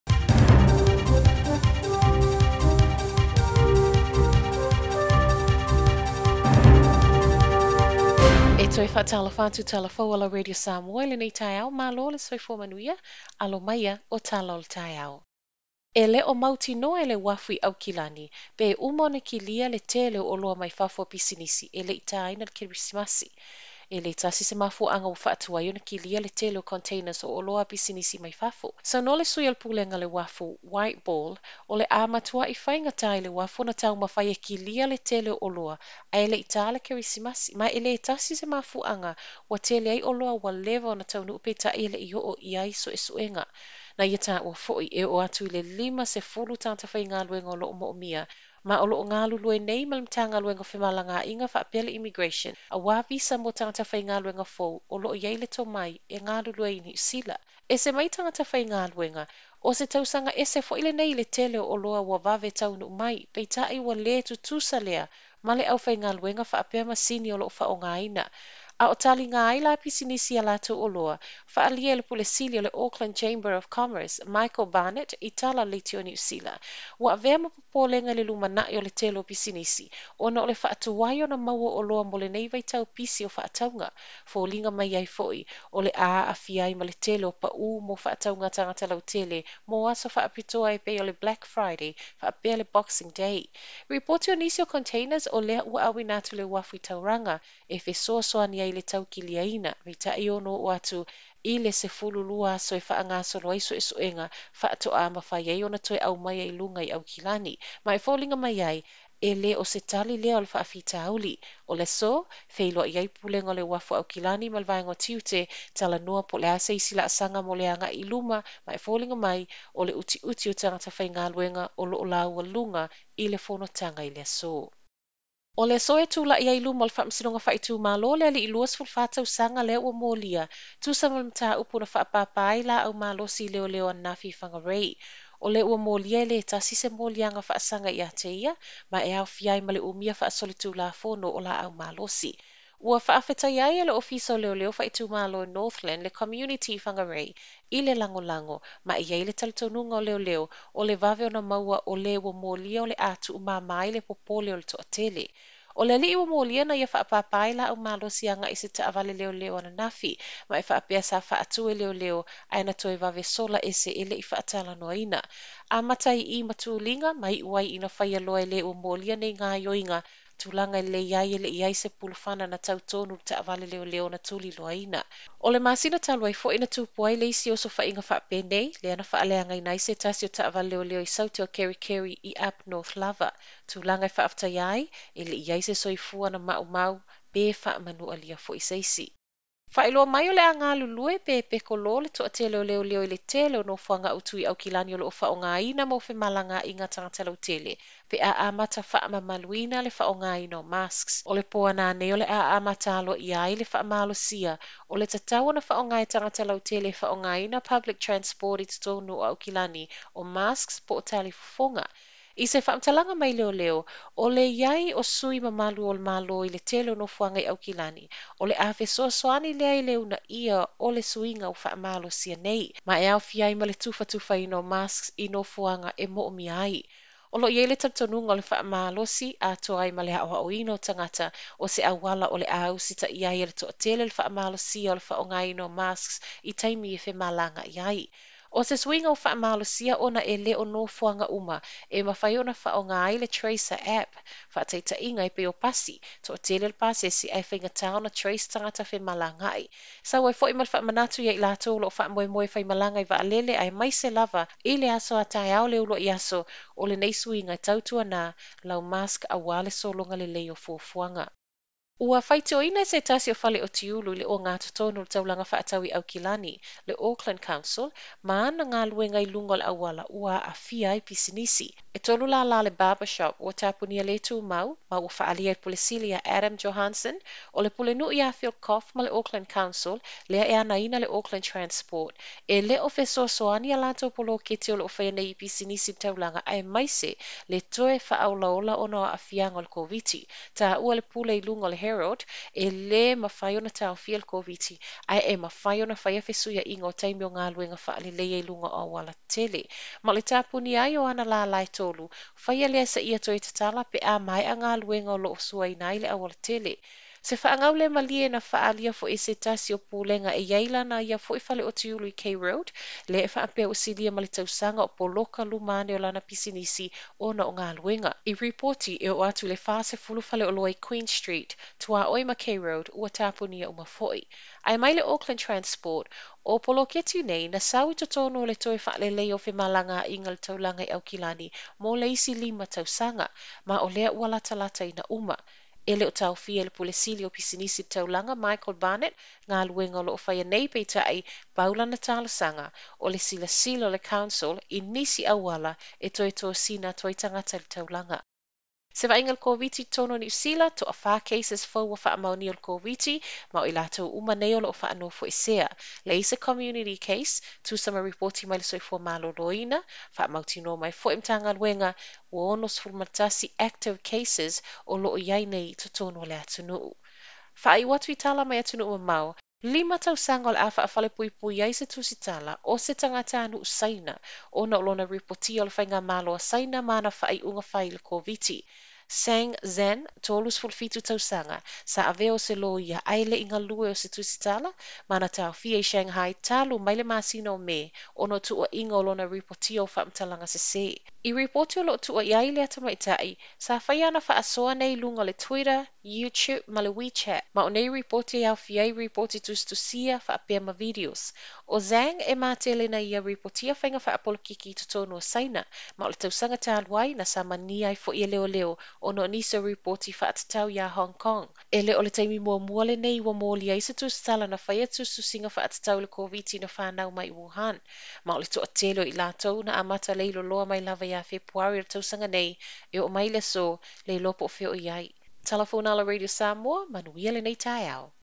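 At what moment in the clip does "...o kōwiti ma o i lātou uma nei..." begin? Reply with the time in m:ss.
5:52.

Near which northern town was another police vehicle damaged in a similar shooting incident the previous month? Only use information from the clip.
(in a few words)
Kerikeri.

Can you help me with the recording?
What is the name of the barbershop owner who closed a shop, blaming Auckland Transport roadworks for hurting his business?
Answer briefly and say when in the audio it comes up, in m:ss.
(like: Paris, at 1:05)
Adam Johansson, at 4:36.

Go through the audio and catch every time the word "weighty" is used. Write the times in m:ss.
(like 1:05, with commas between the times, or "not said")
not said.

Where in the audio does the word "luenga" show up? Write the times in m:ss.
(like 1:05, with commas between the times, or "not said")
2:01, 4:57, 5:04, 6:01.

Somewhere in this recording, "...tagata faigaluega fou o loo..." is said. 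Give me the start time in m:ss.
0:53.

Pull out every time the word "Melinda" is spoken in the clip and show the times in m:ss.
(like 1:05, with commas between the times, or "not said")
not said.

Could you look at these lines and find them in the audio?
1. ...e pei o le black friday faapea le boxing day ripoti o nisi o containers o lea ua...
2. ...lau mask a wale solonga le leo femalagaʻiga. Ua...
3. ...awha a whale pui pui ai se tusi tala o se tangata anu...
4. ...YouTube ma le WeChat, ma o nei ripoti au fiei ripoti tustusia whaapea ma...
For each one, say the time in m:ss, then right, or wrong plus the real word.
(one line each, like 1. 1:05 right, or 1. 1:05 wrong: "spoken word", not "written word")
1. 1:30 right
2. 4:18 wrong: "fuafuanga", not "femalagaʻiga"
3. 6:10 right
4. 6:36 right.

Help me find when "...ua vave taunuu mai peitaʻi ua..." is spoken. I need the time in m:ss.
1:02.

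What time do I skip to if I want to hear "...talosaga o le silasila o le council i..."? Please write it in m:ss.
5:42.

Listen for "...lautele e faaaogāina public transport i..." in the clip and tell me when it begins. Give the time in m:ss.
3:26.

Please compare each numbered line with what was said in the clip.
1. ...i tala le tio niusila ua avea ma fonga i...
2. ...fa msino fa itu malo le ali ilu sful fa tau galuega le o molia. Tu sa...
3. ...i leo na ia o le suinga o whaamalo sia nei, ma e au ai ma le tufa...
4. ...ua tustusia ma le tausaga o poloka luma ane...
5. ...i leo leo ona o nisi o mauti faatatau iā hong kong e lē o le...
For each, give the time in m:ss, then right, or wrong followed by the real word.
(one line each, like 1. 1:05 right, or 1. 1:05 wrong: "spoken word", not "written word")
1. 1:15 wrong: "popolega", not "fonga"
2. 2:06 wrong: "sanga", not "galuega"
3. 3:39 right
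4. 5:13 wrong: "silia", not "tustusia"
5. 6:48 wrong: "ripoti", not "mauti".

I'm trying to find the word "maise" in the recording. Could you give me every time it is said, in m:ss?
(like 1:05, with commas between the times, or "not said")
4:13, 4:46.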